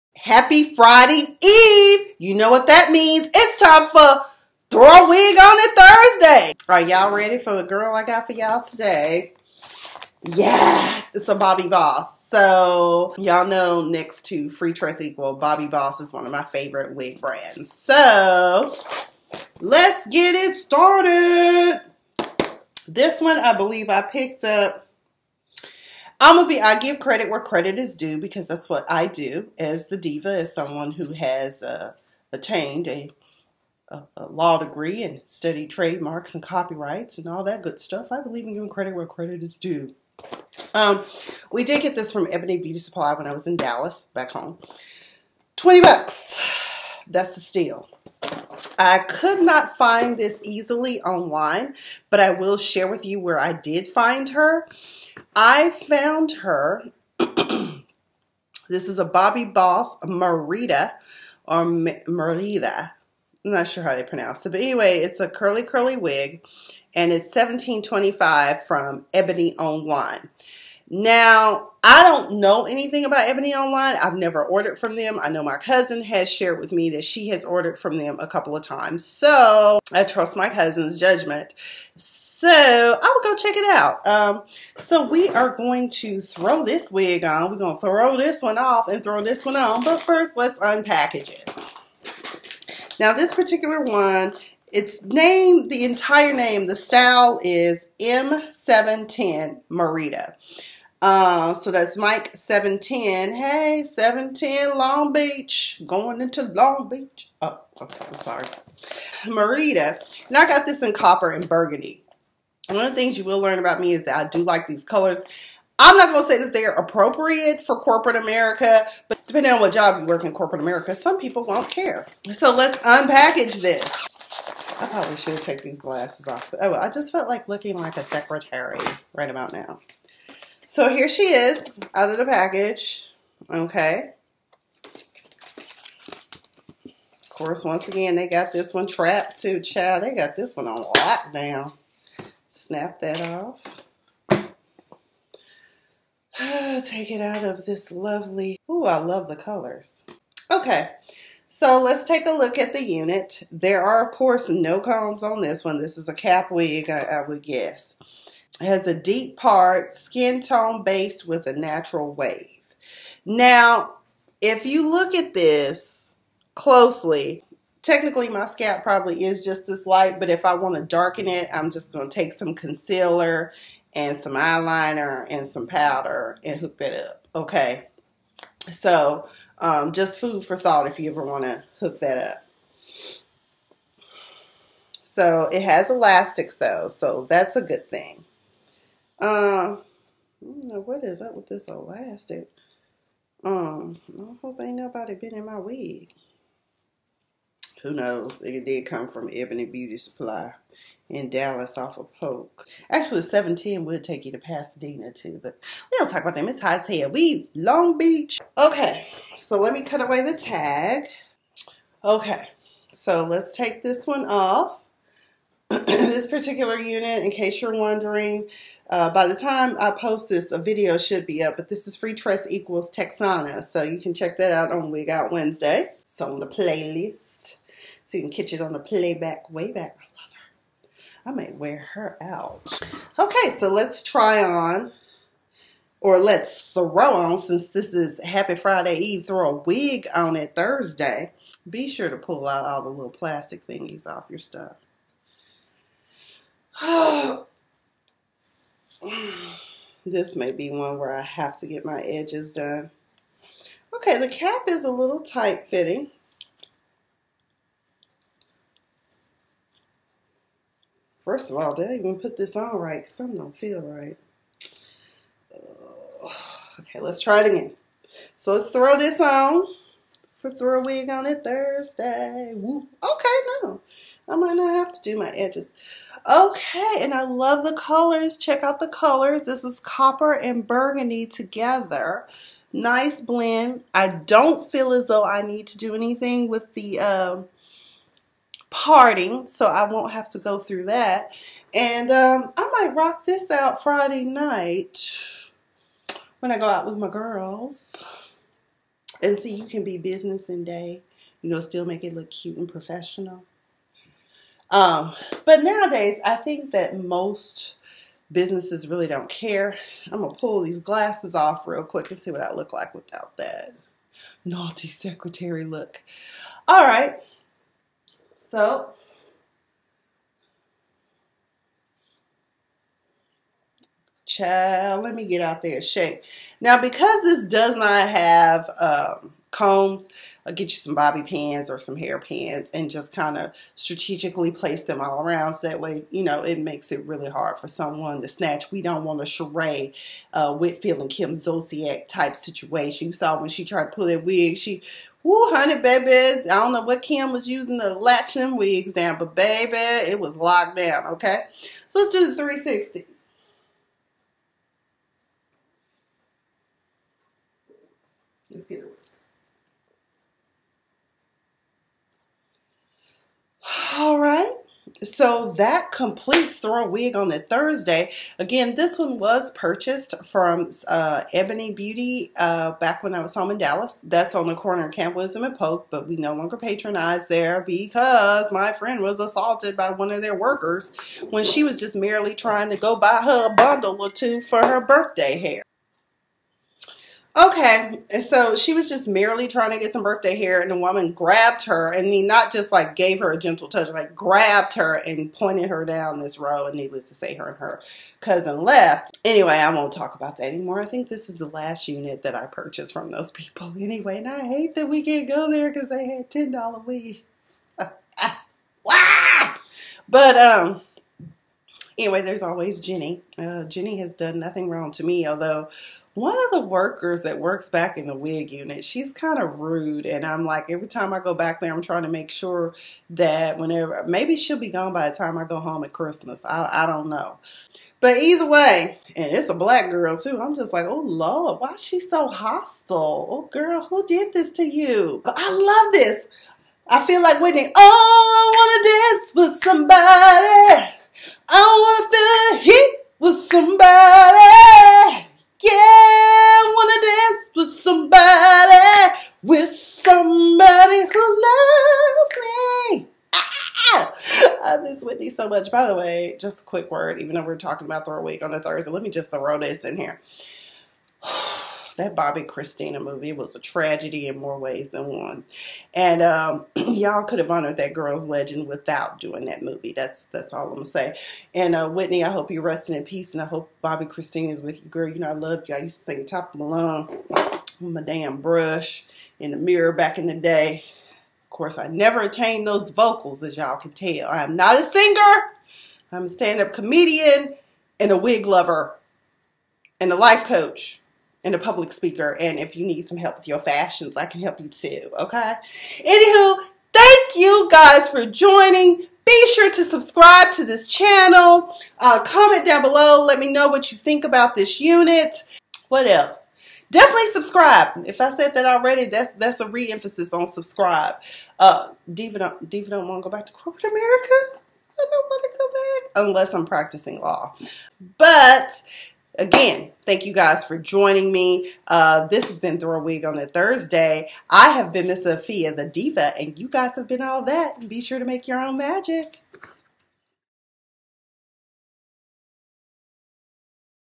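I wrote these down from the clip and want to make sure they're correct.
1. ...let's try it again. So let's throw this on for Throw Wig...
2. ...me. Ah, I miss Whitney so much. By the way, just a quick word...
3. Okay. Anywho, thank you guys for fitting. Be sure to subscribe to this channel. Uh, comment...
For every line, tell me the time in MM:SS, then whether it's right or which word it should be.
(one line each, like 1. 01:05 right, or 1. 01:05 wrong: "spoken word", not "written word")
1. 04:26 right
2. 07:32 right
3. 08:15 wrong: "joining", not "fitting".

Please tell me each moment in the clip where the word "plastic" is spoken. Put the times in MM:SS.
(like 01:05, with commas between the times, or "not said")
04:03.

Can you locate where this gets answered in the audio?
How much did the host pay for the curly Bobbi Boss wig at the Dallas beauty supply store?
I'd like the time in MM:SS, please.
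00:45.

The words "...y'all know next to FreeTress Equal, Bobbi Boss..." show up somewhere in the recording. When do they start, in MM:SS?
00:13.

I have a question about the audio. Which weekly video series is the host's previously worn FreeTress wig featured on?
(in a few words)
Wig Out Wednesday.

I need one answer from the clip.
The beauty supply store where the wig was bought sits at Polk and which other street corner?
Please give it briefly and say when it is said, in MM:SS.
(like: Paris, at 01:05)
Camp Wisdom, at 06:14.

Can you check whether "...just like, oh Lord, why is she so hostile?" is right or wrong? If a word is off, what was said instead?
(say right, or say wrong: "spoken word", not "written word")
right.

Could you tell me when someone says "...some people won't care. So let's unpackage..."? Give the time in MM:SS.
02:00.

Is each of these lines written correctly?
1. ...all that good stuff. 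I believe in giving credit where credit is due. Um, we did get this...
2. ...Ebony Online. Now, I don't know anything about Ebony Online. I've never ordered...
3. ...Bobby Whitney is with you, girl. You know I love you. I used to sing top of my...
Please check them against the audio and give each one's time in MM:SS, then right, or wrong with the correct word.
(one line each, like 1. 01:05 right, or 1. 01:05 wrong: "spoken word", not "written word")
1. 00:37 right
2. 01:09 right
3. 07:53 wrong: "Christina", not "Whitney".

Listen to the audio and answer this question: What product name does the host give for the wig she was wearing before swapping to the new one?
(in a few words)
Texana.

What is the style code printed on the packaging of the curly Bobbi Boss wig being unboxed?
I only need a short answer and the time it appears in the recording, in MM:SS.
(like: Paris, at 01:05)
M710, at 01:38.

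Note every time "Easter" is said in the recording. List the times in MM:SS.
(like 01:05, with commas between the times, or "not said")
not said.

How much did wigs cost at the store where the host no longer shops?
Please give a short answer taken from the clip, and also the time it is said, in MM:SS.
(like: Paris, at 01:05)
$10, at 06:46.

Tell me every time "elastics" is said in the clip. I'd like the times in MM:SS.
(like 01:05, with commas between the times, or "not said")
03:05, 03:11.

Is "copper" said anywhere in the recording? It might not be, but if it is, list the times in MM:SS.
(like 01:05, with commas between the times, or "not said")
01:50, 04:39.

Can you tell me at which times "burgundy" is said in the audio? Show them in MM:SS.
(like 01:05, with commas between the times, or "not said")
01:51, 04:40.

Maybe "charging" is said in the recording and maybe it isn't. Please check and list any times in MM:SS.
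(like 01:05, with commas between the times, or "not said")
not said.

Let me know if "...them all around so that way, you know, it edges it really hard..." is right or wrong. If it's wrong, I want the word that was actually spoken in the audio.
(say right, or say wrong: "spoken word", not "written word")
wrong: "makes", not "edges".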